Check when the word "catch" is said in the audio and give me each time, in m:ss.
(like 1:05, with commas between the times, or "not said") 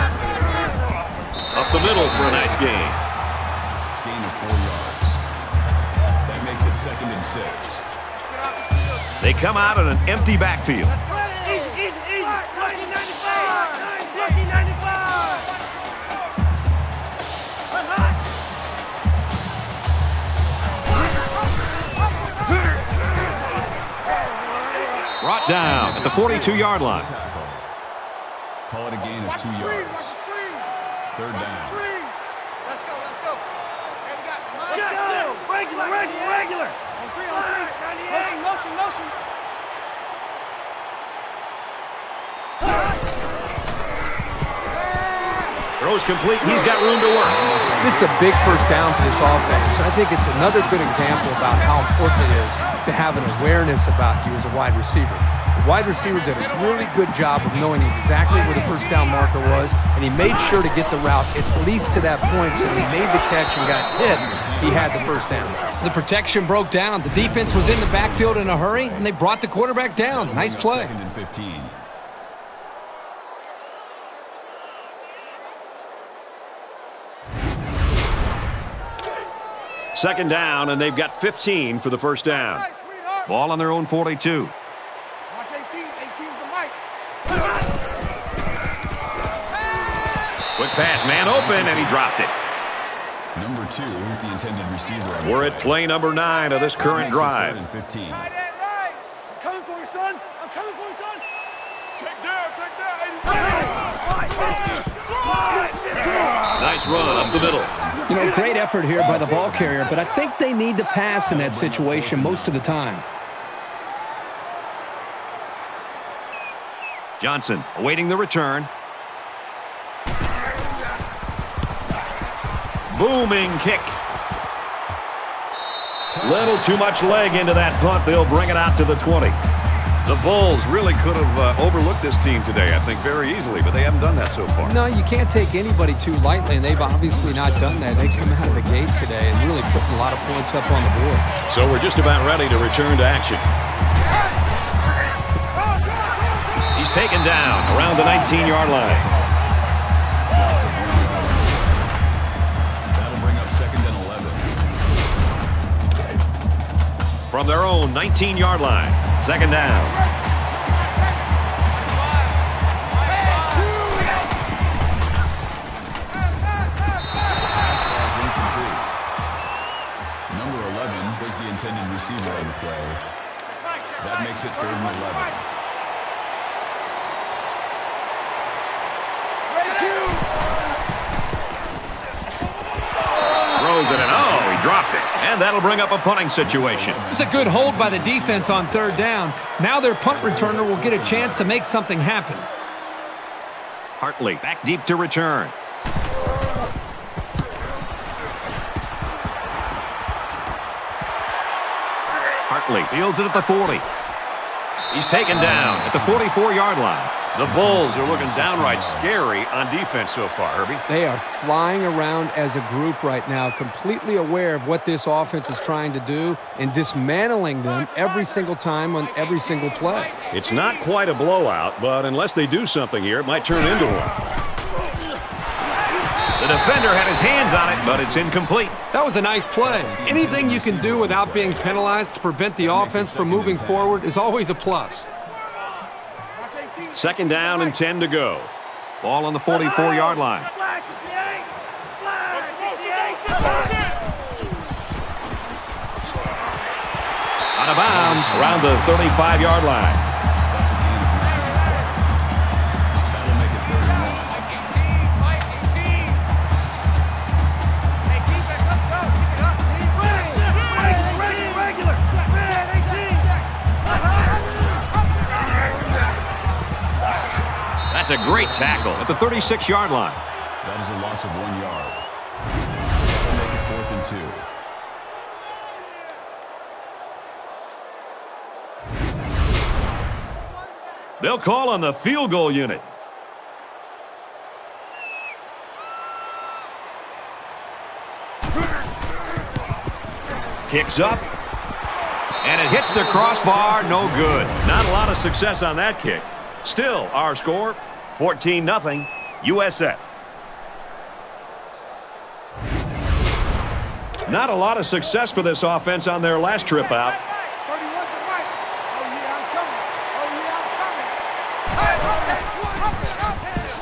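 1:03.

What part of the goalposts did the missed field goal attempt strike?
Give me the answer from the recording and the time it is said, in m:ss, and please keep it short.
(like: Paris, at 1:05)
crossbar, at 4:53.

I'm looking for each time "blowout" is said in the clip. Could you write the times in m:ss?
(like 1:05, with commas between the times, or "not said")
3:41.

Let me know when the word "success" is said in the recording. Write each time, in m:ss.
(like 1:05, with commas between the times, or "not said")
4:55, 5:04.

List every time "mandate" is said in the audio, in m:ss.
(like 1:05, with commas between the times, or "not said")
not said.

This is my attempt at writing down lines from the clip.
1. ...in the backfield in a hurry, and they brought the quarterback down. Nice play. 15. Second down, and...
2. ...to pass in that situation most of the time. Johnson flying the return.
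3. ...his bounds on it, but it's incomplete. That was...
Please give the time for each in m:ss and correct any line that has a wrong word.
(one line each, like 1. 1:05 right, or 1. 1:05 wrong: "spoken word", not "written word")
1. 1:07 right
2. 1:50 wrong: "awaiting", not "flying"
3. 3:47 wrong: "hands", not "bounds".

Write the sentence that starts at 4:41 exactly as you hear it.
They'll call on the field goal unit.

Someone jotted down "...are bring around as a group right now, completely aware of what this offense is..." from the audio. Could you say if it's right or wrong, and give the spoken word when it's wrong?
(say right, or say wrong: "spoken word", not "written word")
wrong: "flying", not "bring".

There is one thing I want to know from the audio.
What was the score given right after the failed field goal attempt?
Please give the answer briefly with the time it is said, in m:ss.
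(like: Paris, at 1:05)
14-0 USF, at 4:58.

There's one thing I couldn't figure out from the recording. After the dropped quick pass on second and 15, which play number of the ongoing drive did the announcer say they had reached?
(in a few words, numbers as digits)
9.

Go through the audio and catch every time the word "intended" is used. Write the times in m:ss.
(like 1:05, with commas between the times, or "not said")
1:34, 2:51.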